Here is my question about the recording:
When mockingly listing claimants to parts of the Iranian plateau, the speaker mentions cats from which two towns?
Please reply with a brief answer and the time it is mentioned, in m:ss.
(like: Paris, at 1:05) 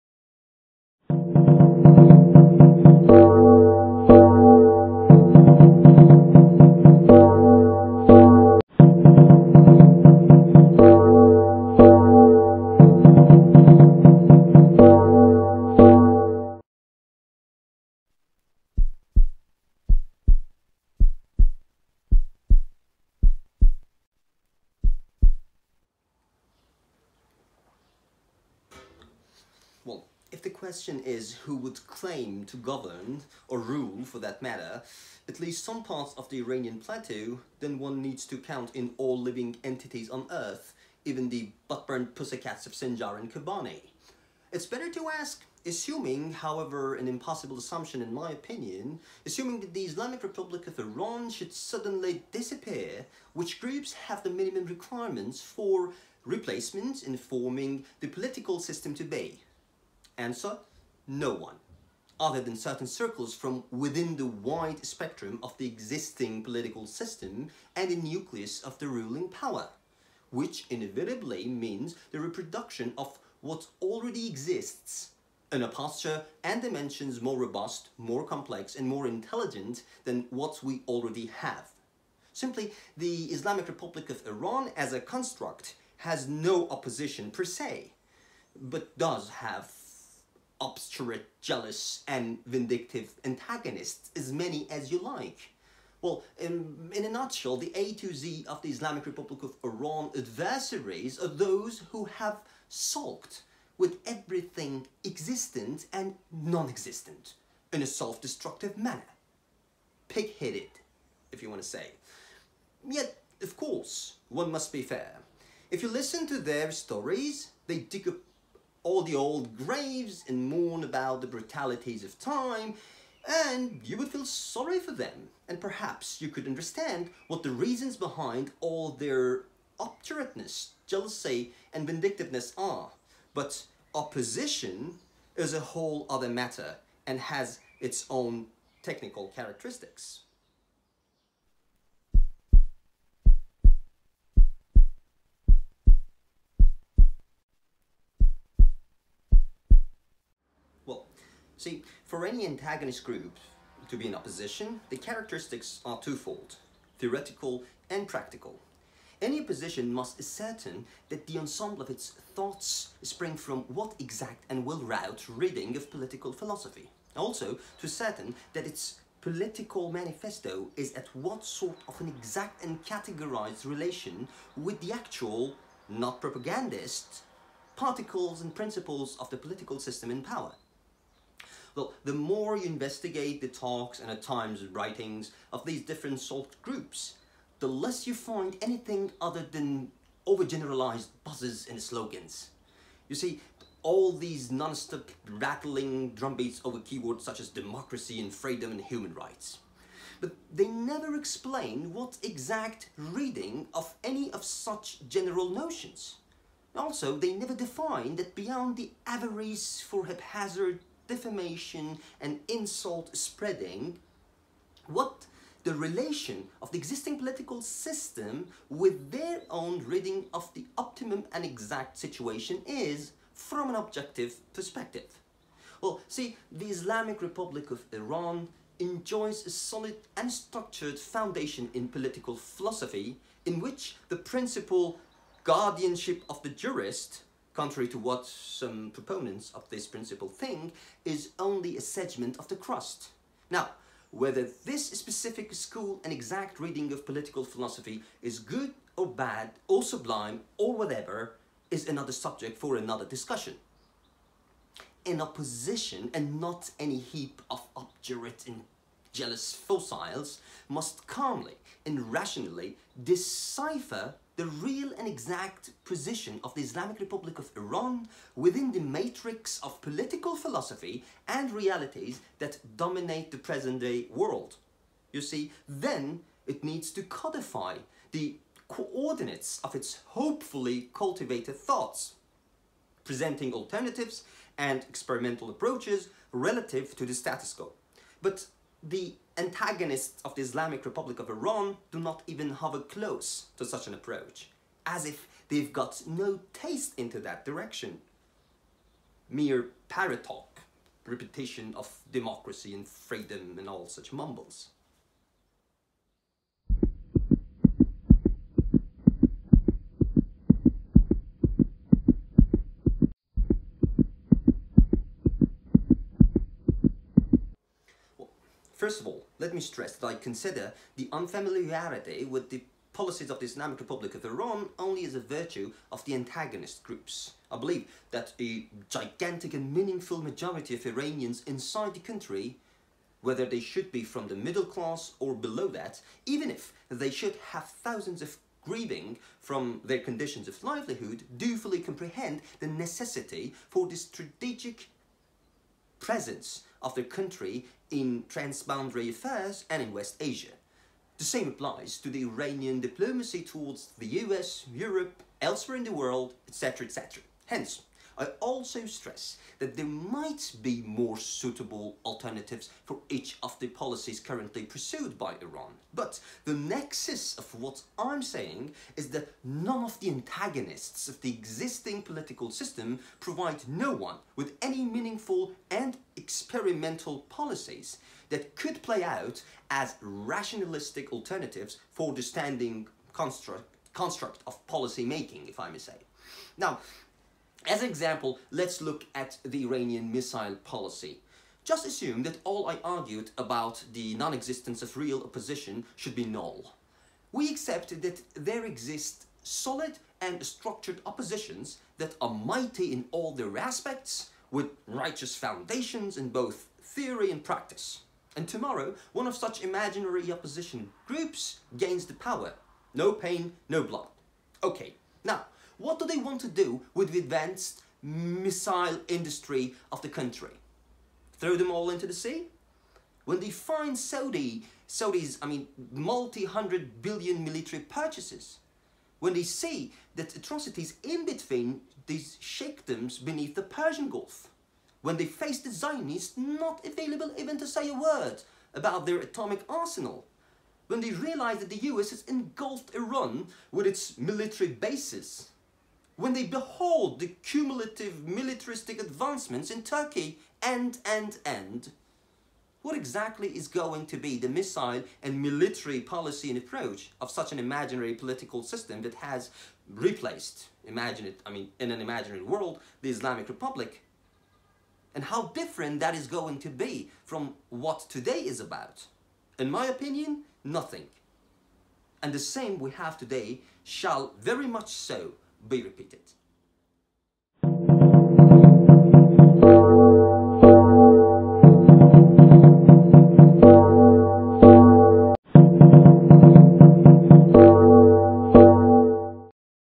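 Sinjar and Kobani, at 0:42.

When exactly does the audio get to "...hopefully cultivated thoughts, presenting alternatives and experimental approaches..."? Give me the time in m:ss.
4:40.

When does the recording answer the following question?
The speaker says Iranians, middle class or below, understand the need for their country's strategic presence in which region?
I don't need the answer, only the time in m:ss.
5:49.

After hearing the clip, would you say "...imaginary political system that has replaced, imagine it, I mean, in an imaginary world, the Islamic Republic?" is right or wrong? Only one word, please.
right.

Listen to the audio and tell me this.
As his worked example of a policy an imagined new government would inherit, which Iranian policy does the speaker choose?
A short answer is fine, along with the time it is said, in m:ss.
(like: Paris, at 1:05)
missile policy, at 6:30.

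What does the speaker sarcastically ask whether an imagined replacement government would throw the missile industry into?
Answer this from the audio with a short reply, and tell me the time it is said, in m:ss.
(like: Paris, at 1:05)
the sea, at 7:02.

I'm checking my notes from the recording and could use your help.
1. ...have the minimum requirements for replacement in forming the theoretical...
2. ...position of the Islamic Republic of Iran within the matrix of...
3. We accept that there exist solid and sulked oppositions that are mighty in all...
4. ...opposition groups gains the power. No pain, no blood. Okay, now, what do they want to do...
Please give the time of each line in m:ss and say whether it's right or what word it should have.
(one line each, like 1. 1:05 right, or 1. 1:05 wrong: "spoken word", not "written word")
1. 0:53 wrong: "political", not "theoretical"
2. 4:25 right
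3. 6:37 wrong: "structured", not "sulked"
4. 6:50 right.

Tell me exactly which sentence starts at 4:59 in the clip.
Mere parrot talk, repetition of democracy and freedom and all such mumbles.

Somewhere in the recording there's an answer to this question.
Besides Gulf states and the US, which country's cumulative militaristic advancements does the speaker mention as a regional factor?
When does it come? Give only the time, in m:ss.
7:29.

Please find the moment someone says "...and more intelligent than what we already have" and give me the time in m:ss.
1:18.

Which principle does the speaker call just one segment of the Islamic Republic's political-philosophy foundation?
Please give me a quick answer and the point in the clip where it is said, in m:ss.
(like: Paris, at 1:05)
guardianship of the jurist, at 3:55.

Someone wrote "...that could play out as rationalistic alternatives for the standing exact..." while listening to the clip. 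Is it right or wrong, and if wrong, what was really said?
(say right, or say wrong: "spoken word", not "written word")
wrong: "construct", not "exact".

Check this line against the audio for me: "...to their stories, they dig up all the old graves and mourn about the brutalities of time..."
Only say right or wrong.
right.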